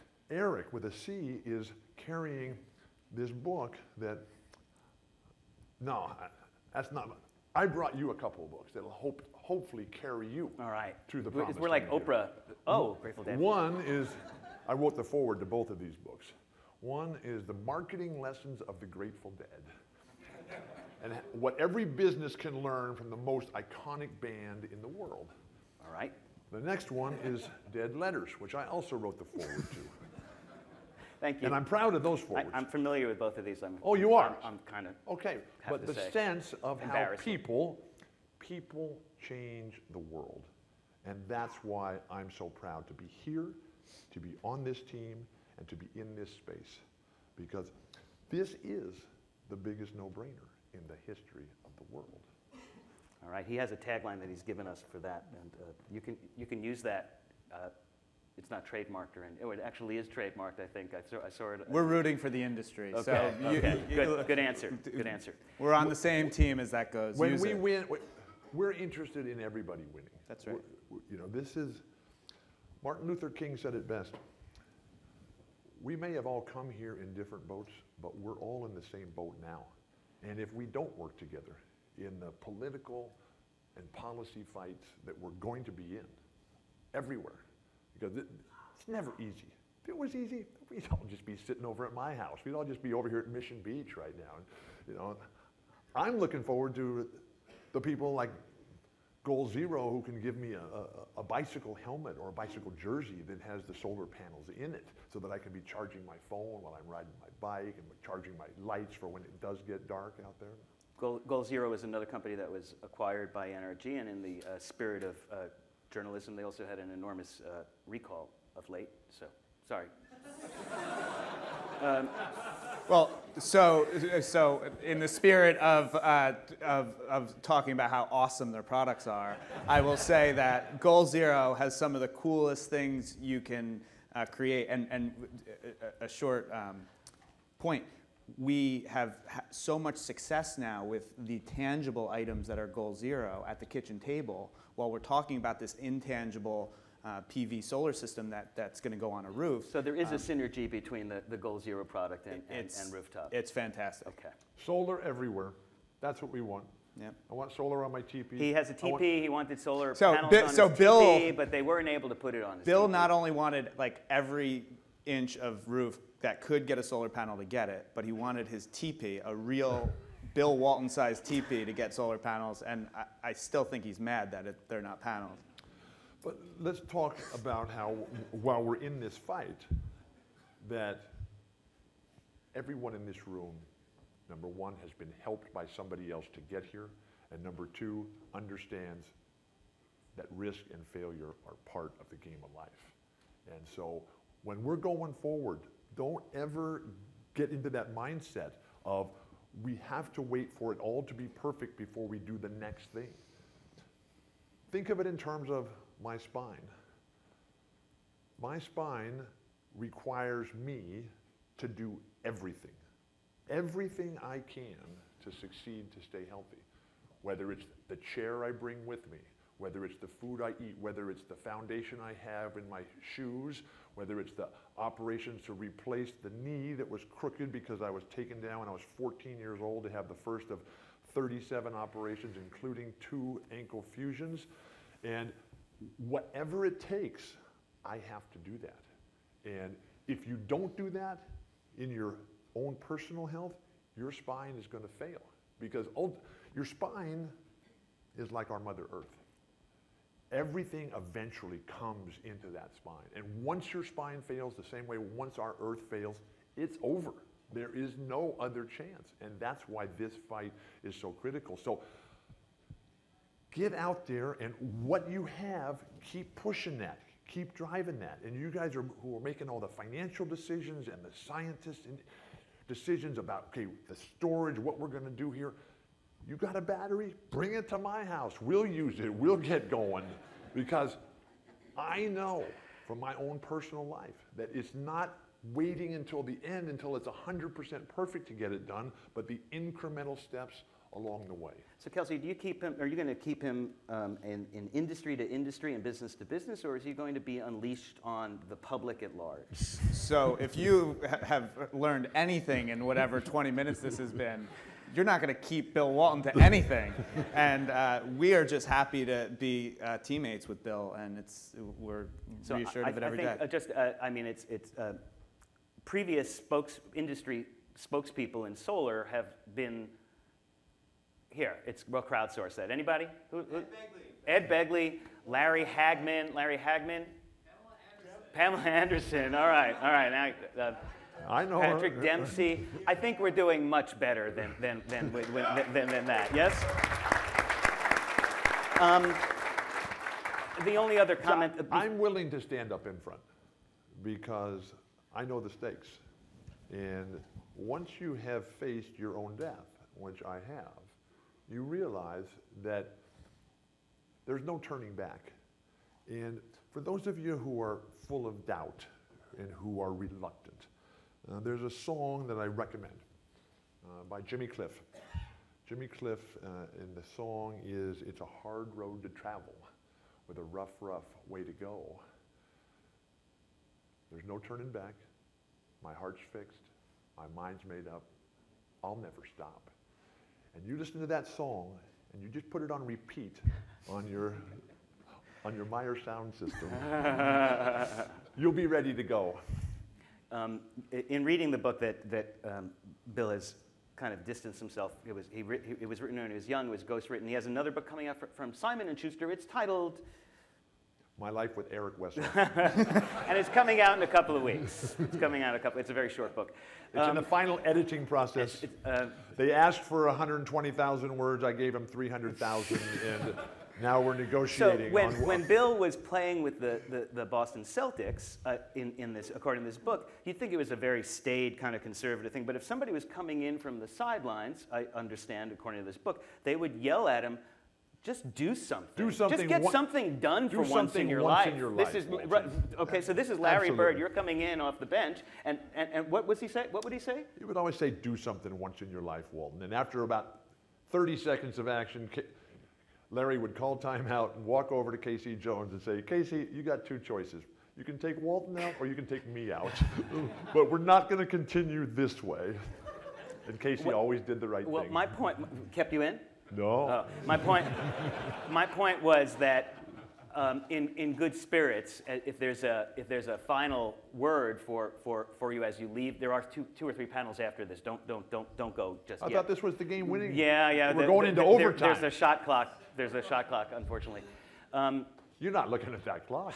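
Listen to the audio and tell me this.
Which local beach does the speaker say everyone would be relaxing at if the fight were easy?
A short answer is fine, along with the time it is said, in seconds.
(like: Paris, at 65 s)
Mission Beach, at 93 s.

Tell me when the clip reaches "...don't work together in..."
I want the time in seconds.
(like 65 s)
80 s.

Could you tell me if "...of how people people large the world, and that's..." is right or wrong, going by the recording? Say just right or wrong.
wrong.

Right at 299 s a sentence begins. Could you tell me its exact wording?
So if you have learned anything in whatever 20 minutes this has been, you're not going to keep Bill Walton to anything.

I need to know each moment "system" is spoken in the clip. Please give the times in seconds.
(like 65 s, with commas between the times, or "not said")
147 s, 386 s.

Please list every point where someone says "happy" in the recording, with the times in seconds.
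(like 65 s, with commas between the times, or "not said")
308 s.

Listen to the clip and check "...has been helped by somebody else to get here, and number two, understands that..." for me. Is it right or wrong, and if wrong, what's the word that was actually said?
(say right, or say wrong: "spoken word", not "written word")
right.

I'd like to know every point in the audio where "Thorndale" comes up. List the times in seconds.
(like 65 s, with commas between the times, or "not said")
not said.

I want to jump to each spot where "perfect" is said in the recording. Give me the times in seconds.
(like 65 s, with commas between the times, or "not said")
201 s, 287 s.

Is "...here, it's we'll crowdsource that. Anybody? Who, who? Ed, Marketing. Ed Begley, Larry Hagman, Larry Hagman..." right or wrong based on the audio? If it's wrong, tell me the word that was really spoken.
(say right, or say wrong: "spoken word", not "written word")
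wrong: "Begley", not "Marketing".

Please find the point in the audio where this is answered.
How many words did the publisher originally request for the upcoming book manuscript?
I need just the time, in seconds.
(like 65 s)
410 s.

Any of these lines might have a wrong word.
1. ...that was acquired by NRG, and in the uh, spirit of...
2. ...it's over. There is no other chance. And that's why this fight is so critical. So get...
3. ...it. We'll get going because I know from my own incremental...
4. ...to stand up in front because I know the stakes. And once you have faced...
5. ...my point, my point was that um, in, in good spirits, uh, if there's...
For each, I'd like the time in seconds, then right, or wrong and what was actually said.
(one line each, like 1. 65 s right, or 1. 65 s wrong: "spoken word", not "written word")
1. 112 s right
2. 256 s right
3. 278 s wrong: "personal", not "incremental"
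4. 342 s right
5. 457 s right.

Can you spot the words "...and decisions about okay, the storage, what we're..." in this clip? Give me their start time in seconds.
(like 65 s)
271 s.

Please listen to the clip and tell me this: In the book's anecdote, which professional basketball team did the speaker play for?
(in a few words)
Boston Celtics.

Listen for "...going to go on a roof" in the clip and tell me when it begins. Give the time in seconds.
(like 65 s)
148 s.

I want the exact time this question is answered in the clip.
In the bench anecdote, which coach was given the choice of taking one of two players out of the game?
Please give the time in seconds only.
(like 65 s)
444 s.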